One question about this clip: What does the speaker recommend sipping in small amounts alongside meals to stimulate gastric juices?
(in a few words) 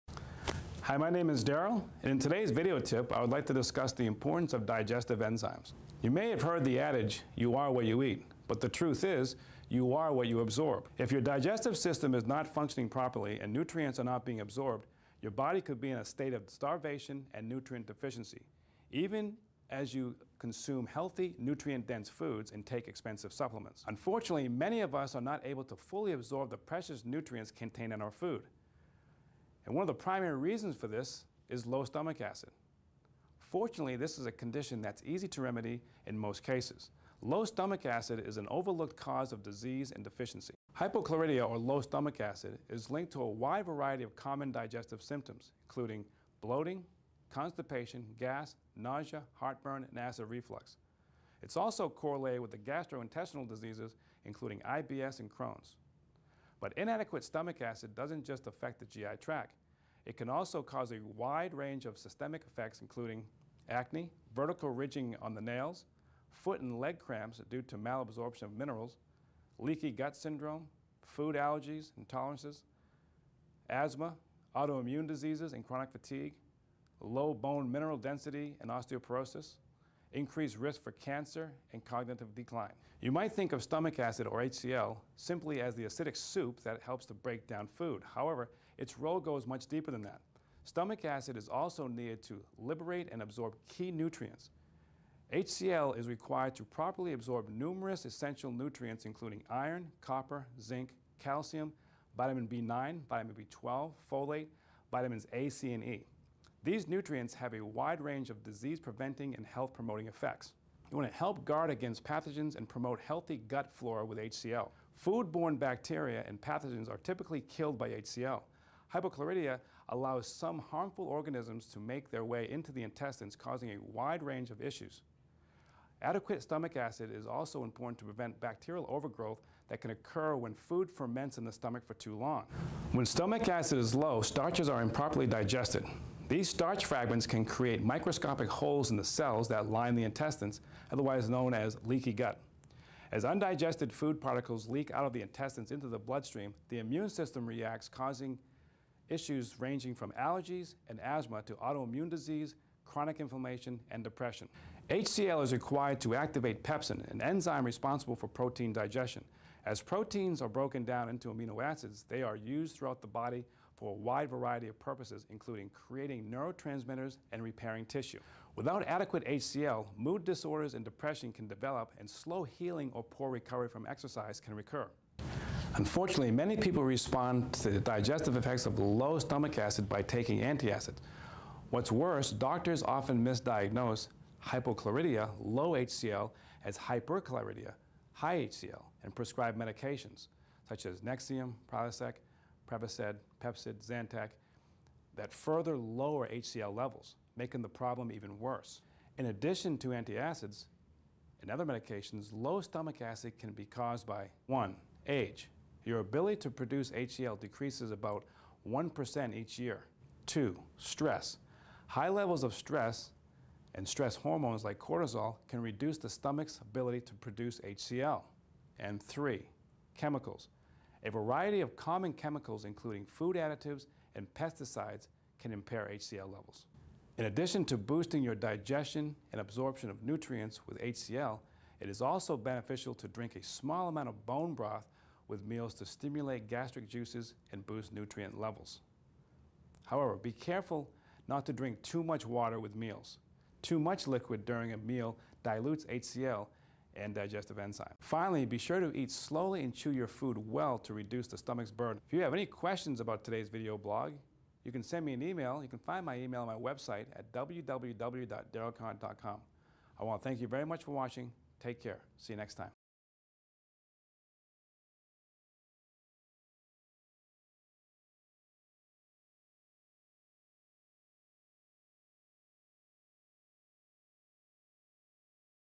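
bone broth.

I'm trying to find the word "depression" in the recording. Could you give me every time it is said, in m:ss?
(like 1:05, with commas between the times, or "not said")
2:34, 2:50.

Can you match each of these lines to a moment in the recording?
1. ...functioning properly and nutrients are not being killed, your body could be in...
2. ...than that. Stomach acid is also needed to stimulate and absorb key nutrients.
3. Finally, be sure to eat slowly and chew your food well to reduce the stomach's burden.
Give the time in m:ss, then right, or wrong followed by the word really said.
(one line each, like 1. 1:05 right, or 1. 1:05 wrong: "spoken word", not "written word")
1. 0:12 wrong: "absorbed", not "killed"
2. 1:29 wrong: "liberate", not "stimulate"
3. 4:07 right.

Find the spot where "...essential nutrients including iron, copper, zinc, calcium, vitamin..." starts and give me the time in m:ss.
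1:38.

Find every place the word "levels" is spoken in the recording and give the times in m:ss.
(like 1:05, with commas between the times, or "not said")
3:16, 3:32, 3:46, 3:58.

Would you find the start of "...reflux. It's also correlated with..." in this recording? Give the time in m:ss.
0:50.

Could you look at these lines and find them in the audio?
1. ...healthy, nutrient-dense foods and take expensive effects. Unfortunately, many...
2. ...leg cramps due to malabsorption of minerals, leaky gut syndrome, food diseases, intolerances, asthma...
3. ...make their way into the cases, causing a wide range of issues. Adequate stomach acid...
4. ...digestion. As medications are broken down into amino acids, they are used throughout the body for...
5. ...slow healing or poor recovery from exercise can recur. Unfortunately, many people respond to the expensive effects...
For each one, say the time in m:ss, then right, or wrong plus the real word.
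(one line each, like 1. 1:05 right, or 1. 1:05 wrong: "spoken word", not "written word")
1. 0:20 wrong: "supplements", not "effects"
2. 1:06 wrong: "allergies", not "diseases"
3. 2:01 wrong: "intestines", not "cases"
4. 2:38 wrong: "proteins", not "medications"
5. 2:52 wrong: "digestive", not "expensive".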